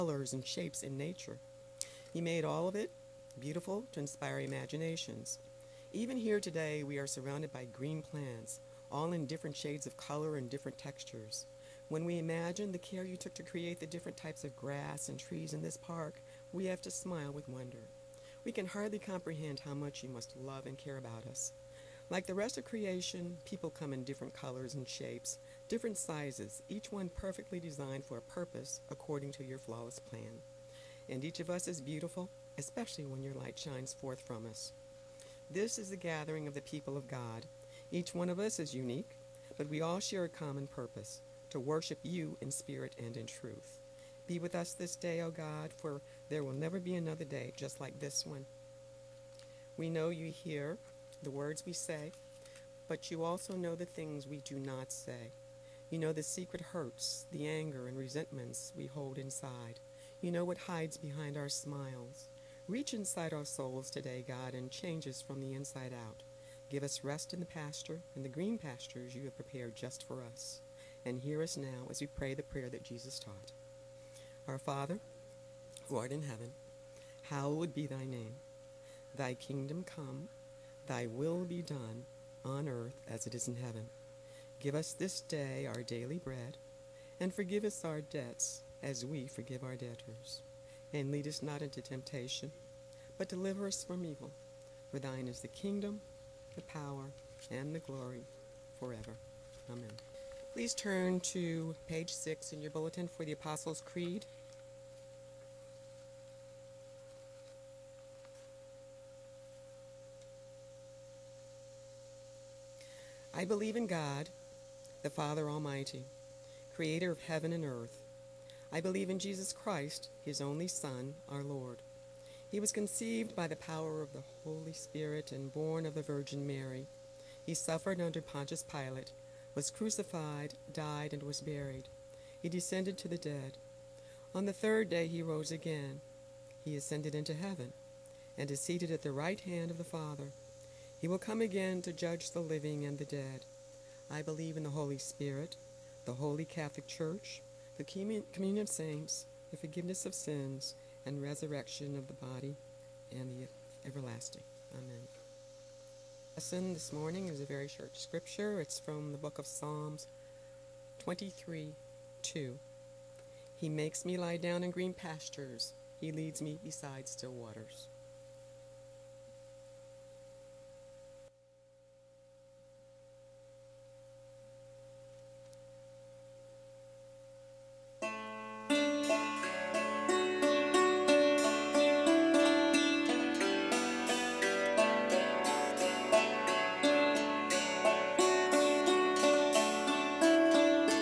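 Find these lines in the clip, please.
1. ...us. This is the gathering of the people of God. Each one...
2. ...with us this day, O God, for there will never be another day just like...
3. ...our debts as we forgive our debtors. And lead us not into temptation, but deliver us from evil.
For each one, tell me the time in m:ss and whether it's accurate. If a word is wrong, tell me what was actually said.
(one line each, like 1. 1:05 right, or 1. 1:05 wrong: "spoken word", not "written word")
1. 0:34 right
2. 0:44 right
3. 1:27 right.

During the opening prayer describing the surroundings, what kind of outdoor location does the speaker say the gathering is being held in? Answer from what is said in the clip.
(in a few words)
park.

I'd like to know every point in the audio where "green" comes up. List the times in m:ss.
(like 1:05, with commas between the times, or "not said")
0:07, 1:08, 2:44.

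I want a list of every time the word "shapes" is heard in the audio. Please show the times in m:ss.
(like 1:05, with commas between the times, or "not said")
0:00, 0:24.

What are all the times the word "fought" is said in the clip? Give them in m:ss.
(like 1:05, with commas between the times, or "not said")
not said.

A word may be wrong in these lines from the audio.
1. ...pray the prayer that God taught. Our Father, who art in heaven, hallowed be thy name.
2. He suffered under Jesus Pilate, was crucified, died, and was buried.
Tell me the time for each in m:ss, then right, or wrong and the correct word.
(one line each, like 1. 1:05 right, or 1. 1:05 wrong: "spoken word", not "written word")
1. 1:12 wrong: "Jesus", not "God"
2. 2:07 wrong: "Pontius", not "Jesus".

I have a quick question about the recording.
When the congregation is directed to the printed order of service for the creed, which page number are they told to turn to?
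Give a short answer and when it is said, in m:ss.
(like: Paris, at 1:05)
6, at 1:42.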